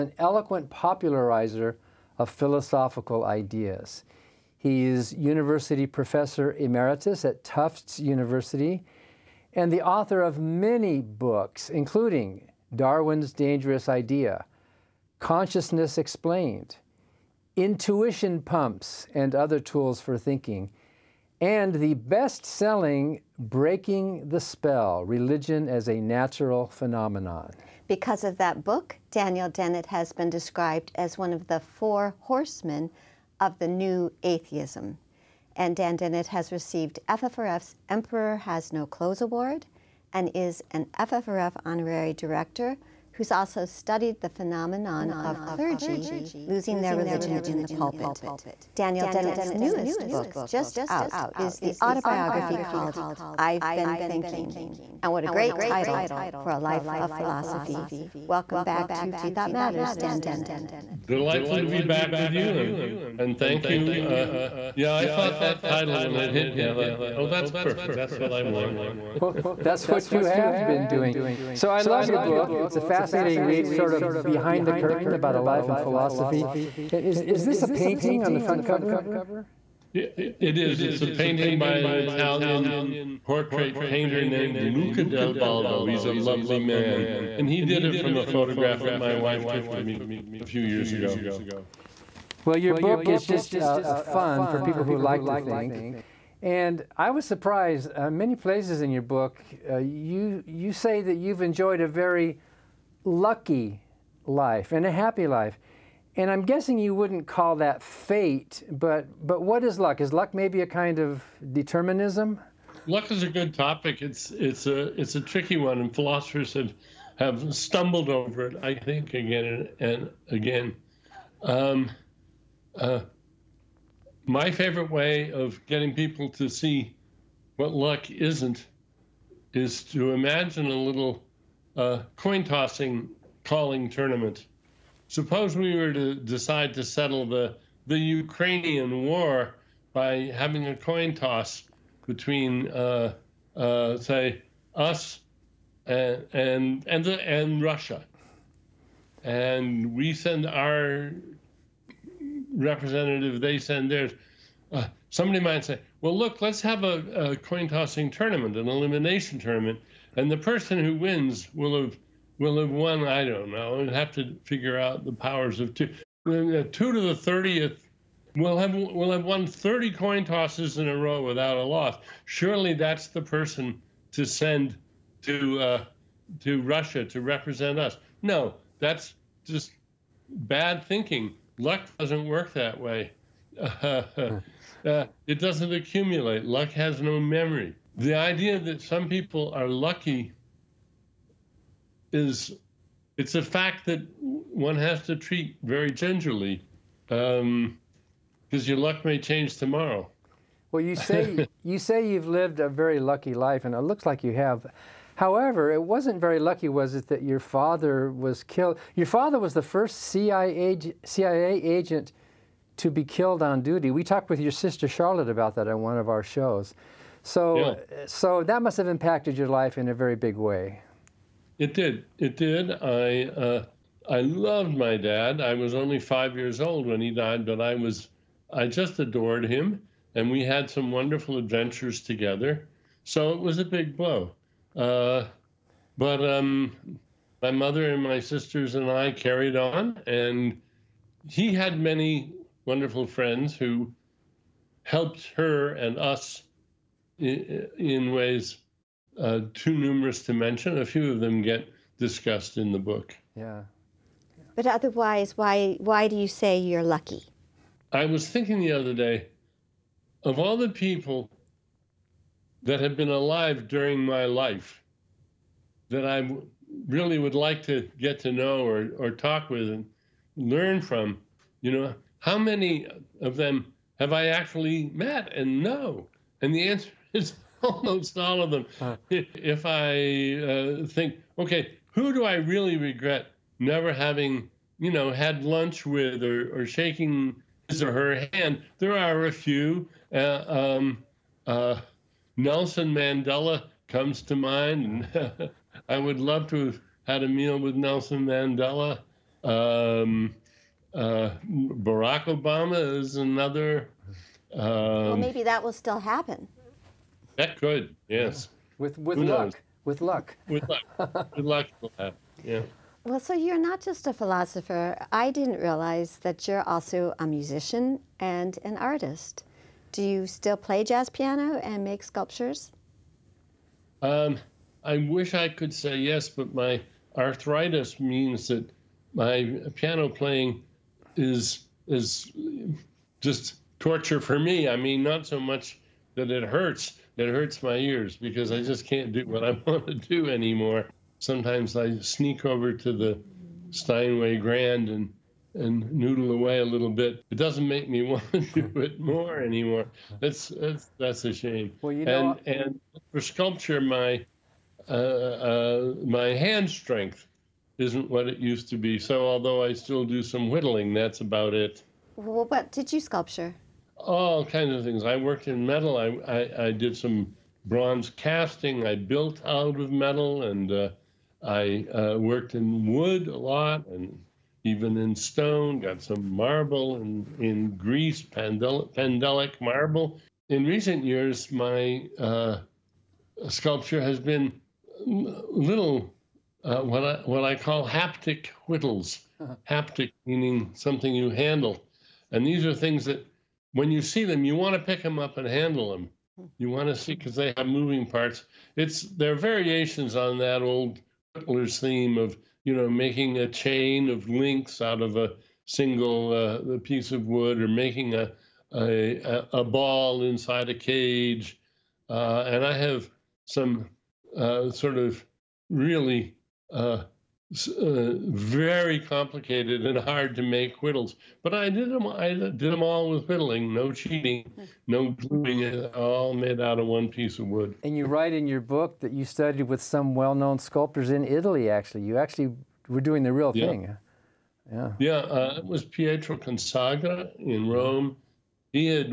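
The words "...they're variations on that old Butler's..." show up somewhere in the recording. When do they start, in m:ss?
6:39.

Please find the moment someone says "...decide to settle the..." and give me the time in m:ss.
2:16.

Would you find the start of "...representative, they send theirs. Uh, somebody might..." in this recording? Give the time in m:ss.
2:32.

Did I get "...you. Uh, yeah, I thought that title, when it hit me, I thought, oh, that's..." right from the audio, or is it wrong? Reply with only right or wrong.
right.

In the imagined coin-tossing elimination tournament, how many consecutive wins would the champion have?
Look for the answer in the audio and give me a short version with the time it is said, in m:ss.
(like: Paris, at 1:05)
30, at 2:49.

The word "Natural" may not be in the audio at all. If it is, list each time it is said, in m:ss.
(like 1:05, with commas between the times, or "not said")
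0:26.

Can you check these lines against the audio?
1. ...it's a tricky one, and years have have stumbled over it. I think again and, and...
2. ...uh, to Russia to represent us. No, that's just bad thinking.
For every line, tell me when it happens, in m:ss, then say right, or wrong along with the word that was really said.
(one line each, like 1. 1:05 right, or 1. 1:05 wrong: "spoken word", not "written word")
1. 1:54 wrong: "philosophers", not "years"
2. 2:55 right.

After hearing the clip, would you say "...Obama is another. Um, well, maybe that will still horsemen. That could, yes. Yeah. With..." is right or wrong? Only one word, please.
wrong.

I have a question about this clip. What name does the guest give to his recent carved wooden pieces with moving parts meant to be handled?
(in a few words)
haptic whittles.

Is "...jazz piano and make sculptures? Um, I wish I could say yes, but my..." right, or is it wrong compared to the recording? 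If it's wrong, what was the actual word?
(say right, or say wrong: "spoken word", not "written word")
right.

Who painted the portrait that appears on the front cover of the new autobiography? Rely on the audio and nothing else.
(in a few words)
Luca Del Baldo.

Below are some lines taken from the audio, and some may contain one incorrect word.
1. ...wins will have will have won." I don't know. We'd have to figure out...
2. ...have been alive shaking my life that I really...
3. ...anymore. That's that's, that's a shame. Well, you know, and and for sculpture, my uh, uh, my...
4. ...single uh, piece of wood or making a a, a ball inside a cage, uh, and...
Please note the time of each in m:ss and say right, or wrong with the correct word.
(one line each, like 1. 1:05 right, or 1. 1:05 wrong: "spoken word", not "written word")
1. 2:40 right
2. 4:22 wrong: "during", not "shaking"
3. 5:49 right
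4. 6:45 right.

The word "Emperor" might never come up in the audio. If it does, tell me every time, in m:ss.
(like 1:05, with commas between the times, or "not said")
0:37.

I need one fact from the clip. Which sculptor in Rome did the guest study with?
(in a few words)
Pietro Consagra.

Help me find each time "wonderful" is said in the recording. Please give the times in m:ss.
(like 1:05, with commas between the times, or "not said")
3:50, 4:02.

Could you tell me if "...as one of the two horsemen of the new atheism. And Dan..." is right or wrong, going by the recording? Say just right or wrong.
wrong.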